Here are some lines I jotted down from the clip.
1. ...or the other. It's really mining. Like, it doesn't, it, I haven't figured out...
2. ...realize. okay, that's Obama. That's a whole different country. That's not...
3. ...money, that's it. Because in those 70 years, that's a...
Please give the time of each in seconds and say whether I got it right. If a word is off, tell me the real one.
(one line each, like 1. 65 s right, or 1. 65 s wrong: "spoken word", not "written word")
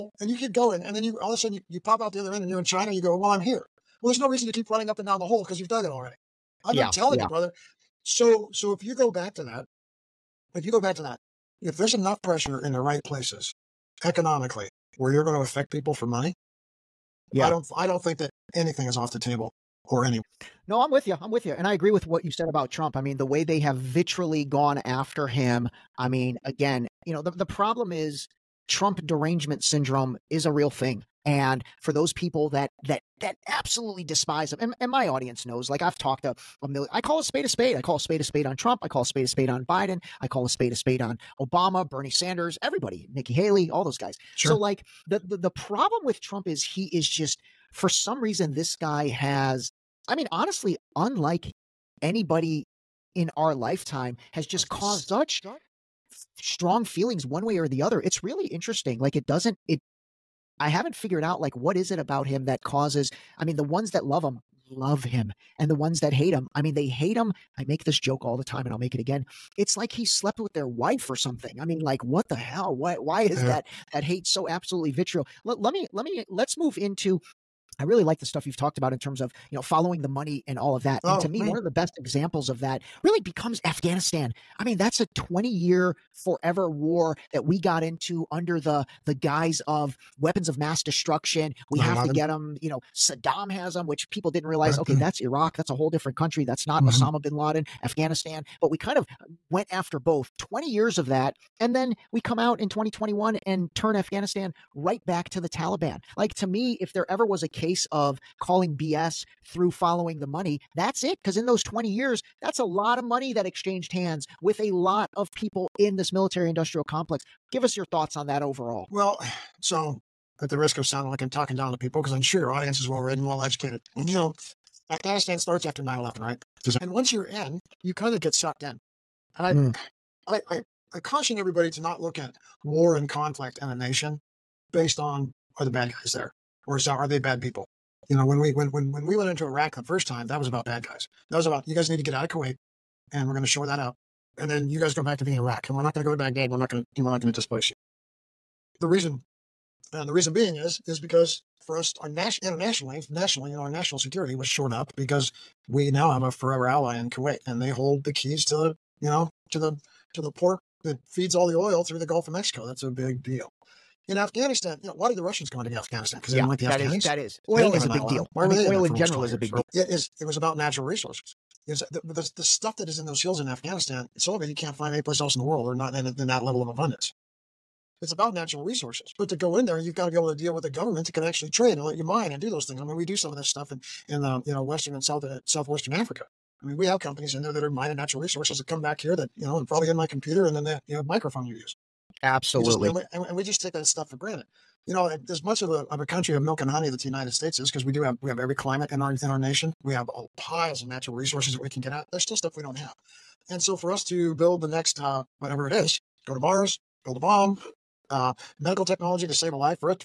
1. 57 s wrong: "interesting", not "mining"
2. 94 s wrong: "Iraq", not "Obama"
3. 110 s wrong: "20", not "70".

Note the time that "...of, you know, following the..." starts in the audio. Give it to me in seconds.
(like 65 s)
79 s.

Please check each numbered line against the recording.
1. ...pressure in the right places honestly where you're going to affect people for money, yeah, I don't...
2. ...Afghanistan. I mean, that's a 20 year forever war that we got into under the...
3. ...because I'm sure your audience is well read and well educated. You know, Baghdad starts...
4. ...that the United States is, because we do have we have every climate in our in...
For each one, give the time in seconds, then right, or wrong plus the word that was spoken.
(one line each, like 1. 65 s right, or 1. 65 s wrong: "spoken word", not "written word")
1. 12 s wrong: "economically", not "honestly"
2. 83 s right
3. 122 s wrong: "Afghanistan", not "Baghdad"
4. 196 s right.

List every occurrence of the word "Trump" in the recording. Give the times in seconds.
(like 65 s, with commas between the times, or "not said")
22 s, 28 s, 38 s, 46 s.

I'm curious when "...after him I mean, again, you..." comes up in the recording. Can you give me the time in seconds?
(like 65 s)
24 s.